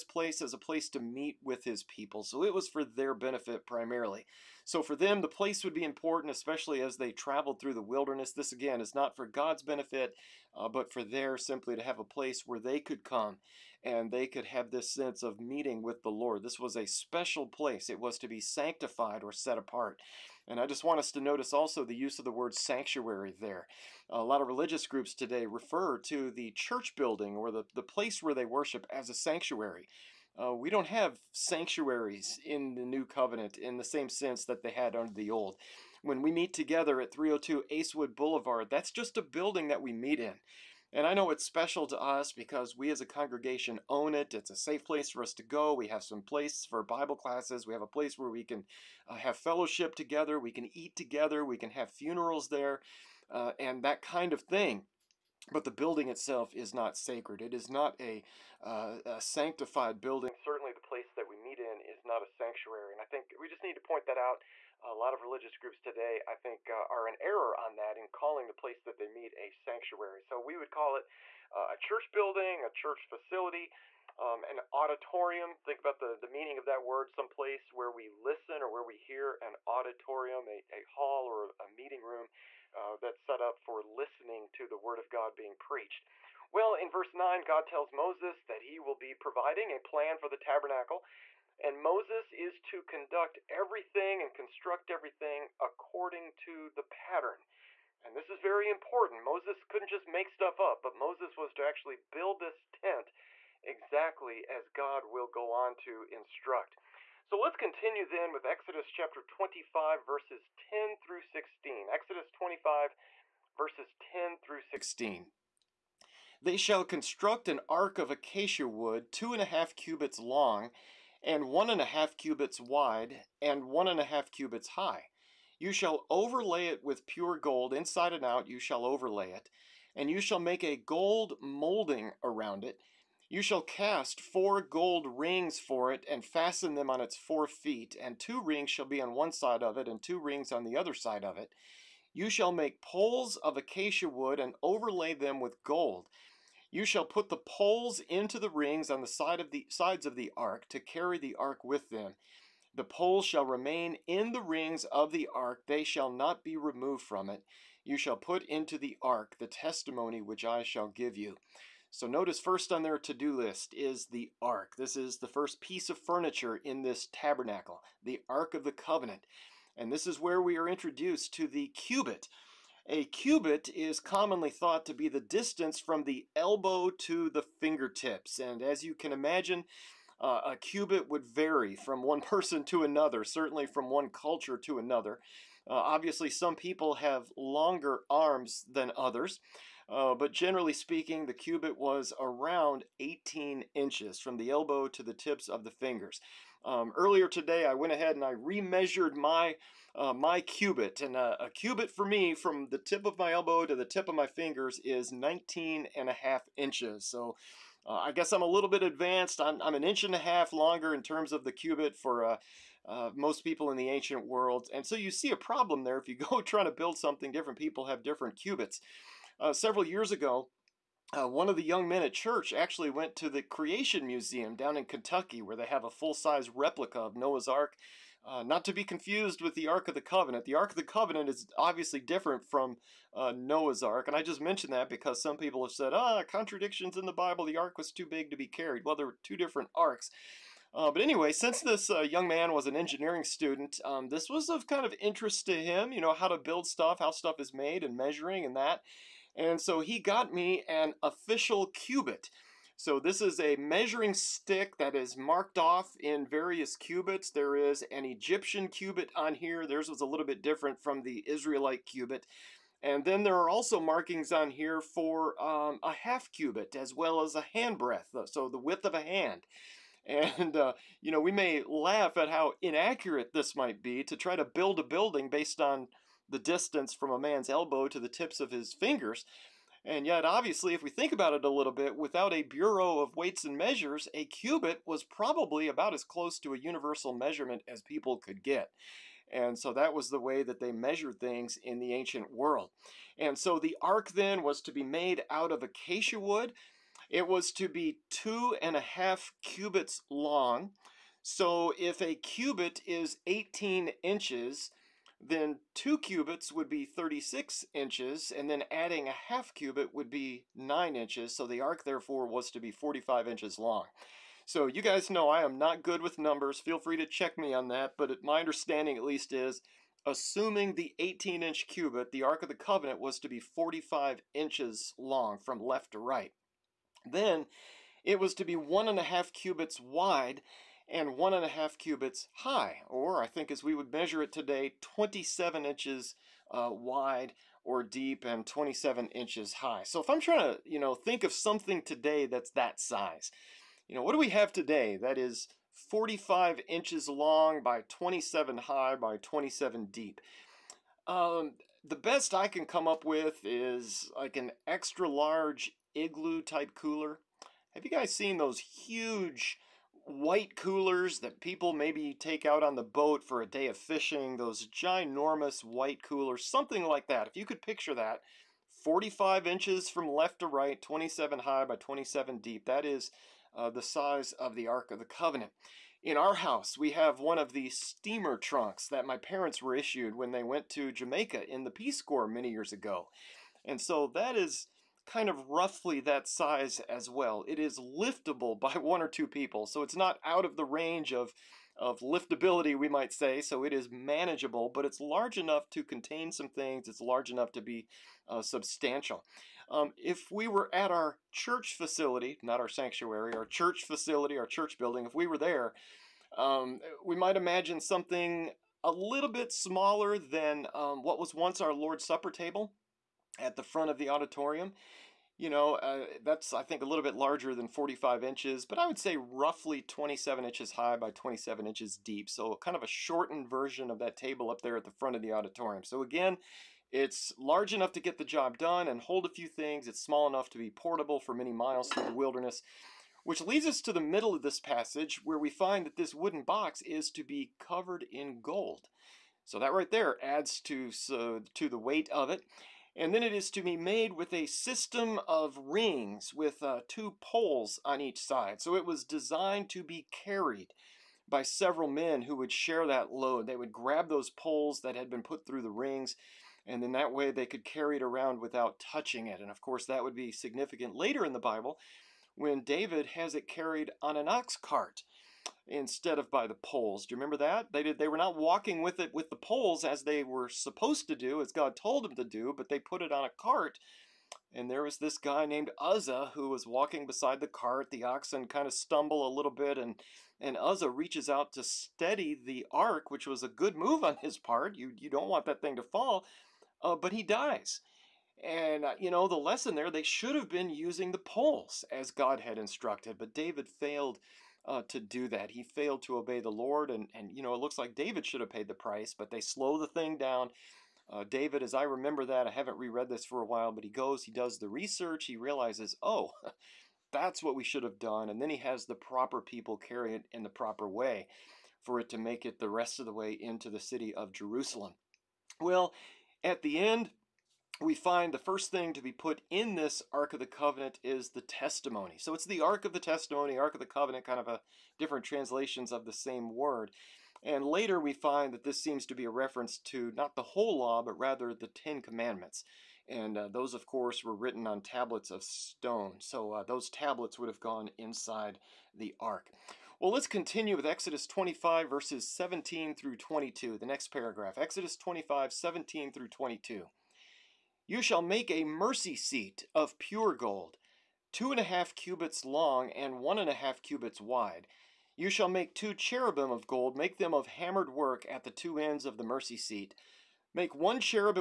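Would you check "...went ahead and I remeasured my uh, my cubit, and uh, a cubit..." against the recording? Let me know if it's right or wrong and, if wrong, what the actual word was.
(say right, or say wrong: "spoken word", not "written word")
right.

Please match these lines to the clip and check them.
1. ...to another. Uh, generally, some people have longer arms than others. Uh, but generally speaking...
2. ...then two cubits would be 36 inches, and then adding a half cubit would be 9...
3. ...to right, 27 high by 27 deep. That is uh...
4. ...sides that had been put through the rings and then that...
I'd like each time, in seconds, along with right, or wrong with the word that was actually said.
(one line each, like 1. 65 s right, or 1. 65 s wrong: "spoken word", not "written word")
1. 184 s wrong: "obviously", not "generally"
2. 305 s right
3. 370 s right
4. 454 s wrong: "poles", not "sides".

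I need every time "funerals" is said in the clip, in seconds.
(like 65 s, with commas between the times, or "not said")
51 s.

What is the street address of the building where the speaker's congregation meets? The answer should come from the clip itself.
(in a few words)
302 Acewood Boulevard.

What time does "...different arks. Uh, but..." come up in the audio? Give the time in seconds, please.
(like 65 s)
239 s.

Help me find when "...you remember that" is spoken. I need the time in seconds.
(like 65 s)
467 s.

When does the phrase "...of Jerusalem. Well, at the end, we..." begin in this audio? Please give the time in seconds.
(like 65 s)
514 s.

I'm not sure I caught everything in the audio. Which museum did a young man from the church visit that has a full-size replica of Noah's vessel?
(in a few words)
Creation Museum.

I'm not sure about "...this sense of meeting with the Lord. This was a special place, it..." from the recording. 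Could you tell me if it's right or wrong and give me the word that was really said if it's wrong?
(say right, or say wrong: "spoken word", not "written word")
right.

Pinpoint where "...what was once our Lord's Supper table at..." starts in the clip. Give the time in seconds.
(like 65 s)
411 s.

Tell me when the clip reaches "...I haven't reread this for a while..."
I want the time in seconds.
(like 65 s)
502 s.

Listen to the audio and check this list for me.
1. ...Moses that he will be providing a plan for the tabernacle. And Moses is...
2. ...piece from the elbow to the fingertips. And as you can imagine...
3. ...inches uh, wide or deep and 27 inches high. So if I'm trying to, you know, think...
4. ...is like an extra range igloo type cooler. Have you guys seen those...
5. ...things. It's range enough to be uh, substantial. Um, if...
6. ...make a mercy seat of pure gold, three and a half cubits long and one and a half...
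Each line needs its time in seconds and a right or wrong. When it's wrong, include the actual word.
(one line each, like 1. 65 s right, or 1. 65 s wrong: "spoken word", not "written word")
1. 87 s right
2. 175 s wrong: "distance", not "piece"
3. 335 s right
4. 353 s wrong: "large", not "range"
5. 396 s wrong: "large", not "range"
6. 548 s wrong: "two", not "three".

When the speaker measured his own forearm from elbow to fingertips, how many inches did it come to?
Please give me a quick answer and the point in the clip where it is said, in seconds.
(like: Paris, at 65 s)
19 and a half inches, at 205 s.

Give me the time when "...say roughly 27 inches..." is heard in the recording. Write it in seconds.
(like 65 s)
418 s.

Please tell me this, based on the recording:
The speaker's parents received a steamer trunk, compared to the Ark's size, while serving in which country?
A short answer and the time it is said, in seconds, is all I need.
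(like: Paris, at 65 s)
Jamaica, at 380 s.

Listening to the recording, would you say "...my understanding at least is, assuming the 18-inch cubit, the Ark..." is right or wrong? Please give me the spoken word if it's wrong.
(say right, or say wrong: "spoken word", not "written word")
right.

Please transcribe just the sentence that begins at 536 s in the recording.
So uh, those tablets would have gone inside the ark.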